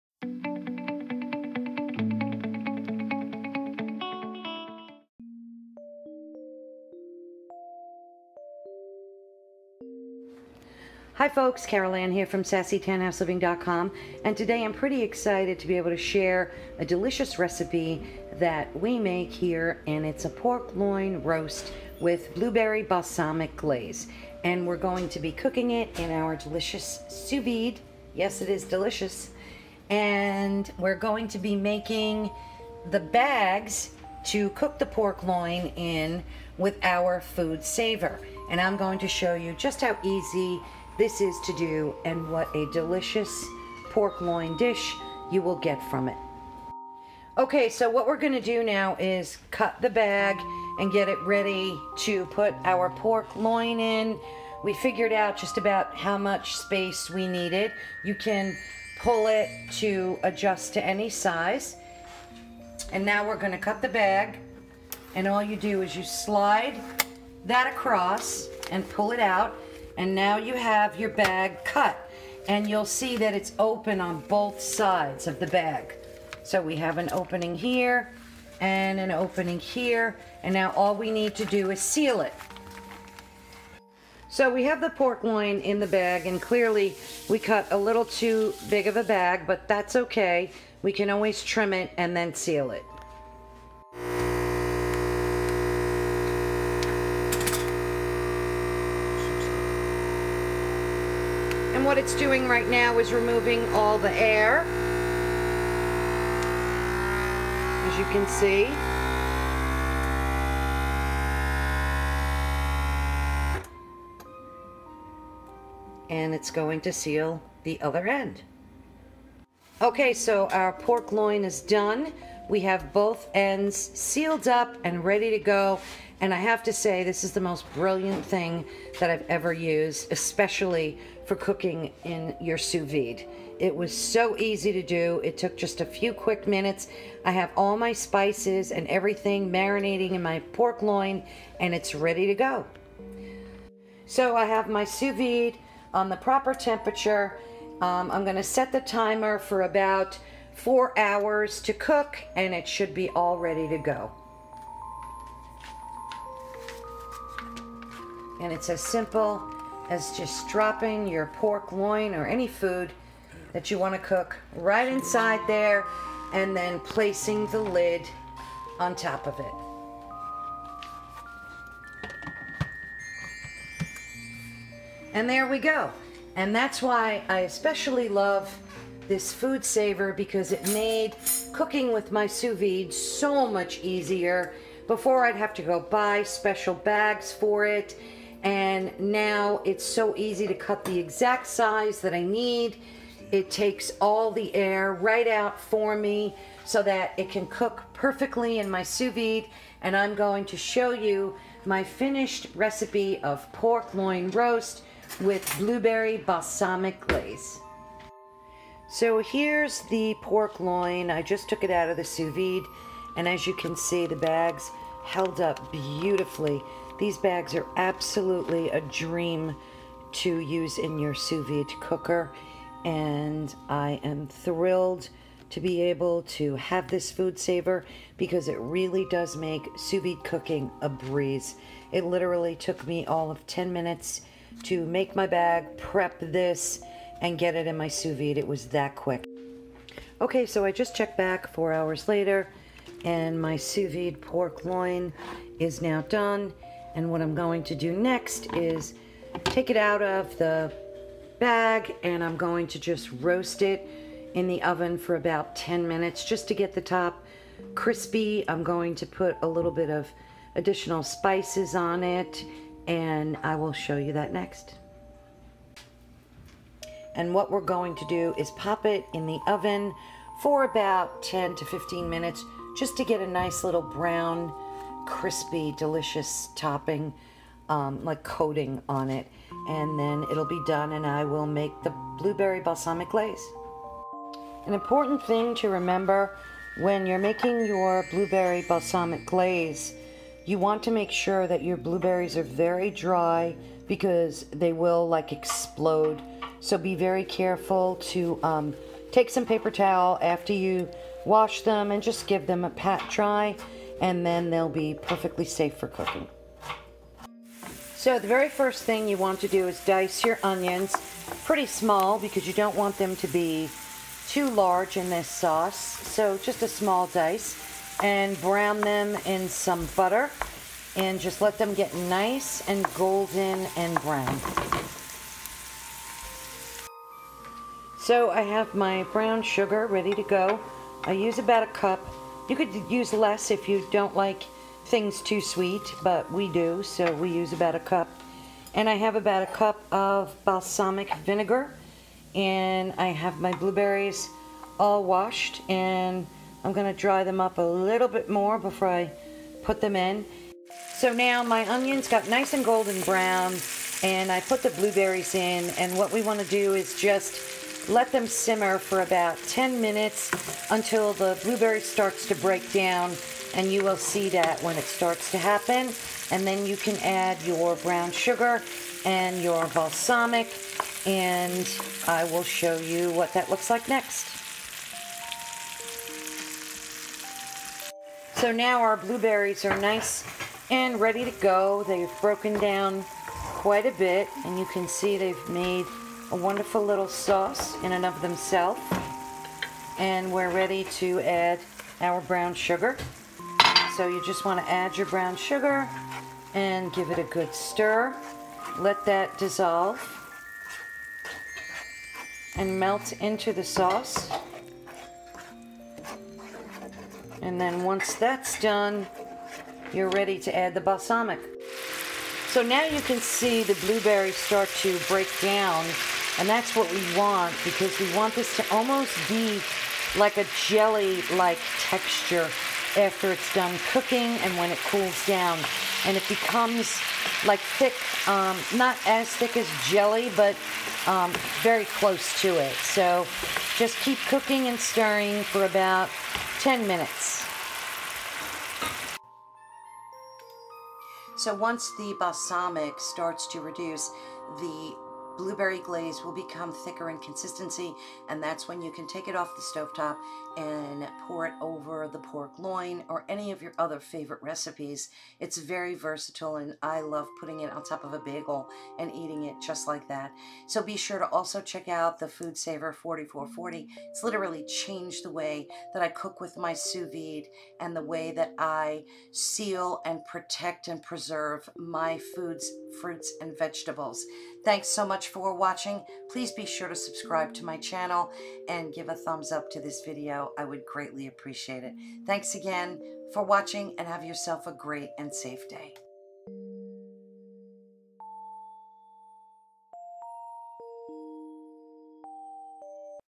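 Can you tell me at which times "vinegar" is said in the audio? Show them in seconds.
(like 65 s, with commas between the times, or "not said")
341 s.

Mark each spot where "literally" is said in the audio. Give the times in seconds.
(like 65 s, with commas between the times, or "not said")
232 s, 464 s.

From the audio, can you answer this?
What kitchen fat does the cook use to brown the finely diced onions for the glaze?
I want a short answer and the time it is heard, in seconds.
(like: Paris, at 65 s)
butter, at 319 s.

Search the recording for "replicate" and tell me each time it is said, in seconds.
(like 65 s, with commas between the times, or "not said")
not said.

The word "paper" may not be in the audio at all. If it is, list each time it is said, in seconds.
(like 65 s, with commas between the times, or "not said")
299 s.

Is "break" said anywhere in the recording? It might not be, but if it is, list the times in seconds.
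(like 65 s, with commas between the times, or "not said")
362 s, 415 s.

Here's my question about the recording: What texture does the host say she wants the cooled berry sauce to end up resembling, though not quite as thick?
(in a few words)
jelly-like.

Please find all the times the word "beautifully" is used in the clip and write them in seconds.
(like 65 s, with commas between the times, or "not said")
215 s.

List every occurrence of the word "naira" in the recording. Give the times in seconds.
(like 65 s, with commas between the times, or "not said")
not said.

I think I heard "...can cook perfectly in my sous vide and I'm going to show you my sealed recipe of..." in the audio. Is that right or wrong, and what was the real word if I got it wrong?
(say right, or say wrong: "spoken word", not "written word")
wrong: "finished", not "sealed".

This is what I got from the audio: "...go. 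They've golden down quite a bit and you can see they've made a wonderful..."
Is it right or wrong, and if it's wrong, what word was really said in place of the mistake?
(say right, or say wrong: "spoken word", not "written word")
wrong: "broken", not "golden".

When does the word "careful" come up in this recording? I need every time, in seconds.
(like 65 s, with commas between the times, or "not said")
297 s.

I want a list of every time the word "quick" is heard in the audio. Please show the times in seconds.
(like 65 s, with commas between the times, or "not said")
136 s, 238 s.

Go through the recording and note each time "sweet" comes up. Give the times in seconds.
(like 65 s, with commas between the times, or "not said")
335 s.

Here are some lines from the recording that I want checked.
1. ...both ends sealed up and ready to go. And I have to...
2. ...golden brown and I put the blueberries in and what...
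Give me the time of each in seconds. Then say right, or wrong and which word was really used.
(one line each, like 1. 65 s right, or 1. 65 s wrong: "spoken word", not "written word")
1. 122 s right
2. 352 s right.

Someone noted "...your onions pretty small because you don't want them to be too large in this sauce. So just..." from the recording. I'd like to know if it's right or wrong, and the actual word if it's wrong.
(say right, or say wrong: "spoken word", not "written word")
right.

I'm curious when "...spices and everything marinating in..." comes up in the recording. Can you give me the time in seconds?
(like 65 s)
137 s.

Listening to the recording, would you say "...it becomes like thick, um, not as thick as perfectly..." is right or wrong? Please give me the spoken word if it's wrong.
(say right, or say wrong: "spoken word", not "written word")
wrong: "jelly", not "perfectly".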